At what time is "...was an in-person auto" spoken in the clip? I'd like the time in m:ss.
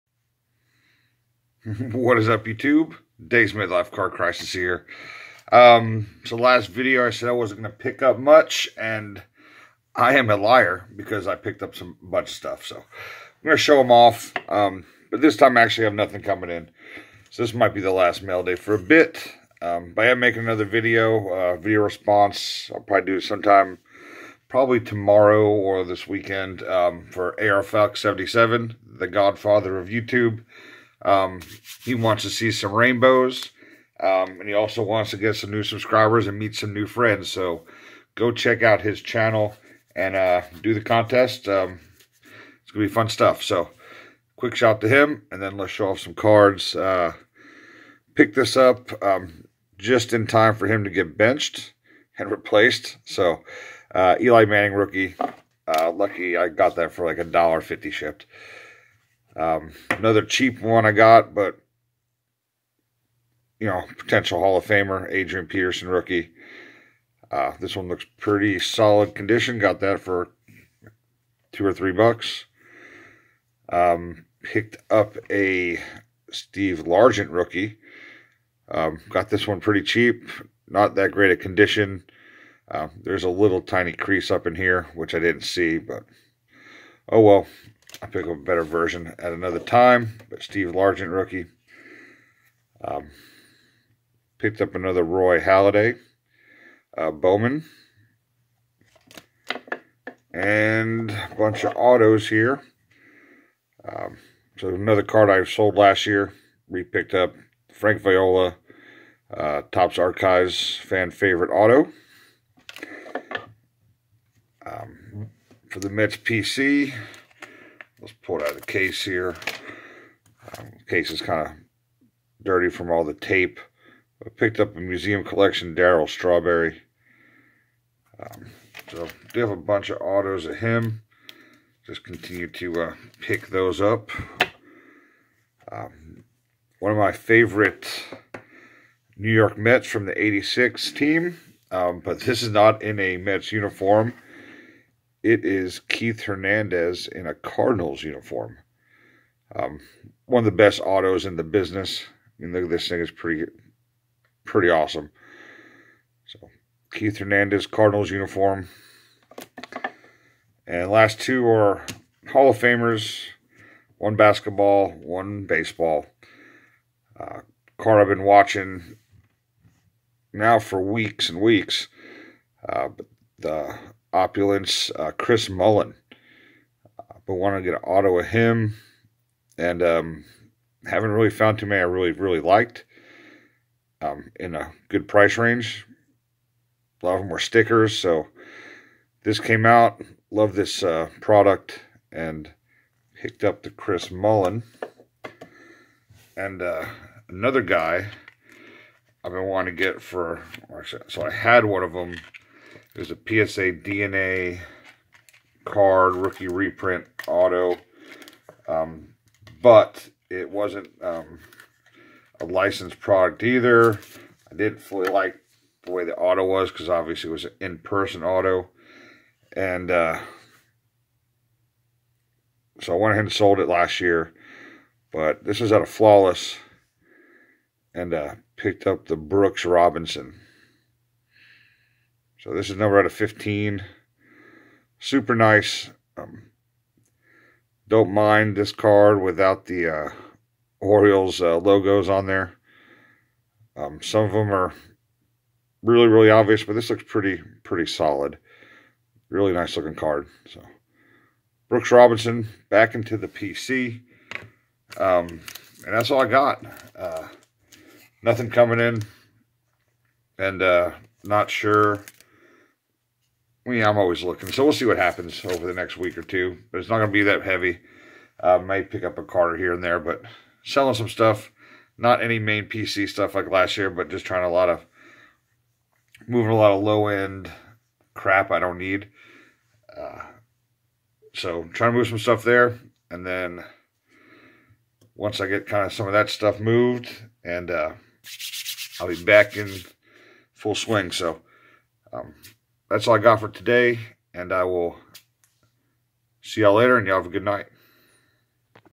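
3:37.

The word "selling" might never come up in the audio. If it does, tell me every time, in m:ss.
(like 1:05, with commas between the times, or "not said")
4:30.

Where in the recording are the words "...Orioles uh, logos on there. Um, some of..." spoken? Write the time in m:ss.
4:00.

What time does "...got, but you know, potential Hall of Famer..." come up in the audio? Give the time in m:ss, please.
1:00.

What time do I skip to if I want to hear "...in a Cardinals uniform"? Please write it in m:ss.
2:27.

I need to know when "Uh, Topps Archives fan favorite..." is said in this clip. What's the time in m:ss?
1:49.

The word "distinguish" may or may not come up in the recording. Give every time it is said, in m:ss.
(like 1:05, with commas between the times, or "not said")
not said.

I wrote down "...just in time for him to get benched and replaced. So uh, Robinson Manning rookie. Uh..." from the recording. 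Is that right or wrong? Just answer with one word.
wrong.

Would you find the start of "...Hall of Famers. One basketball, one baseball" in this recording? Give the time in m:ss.
2:42.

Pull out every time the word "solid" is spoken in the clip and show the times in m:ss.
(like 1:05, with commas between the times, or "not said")
1:08, 4:07.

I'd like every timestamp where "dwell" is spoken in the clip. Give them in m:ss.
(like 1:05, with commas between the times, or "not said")
not said.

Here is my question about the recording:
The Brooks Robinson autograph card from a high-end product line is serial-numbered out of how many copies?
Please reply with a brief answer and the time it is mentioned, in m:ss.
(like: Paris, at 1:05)
15, at 3:53.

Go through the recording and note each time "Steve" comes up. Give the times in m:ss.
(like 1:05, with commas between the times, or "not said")
1:16, 1:30.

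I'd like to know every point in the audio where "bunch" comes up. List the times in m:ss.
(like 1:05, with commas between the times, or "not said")
0:12, 1:41, 2:09.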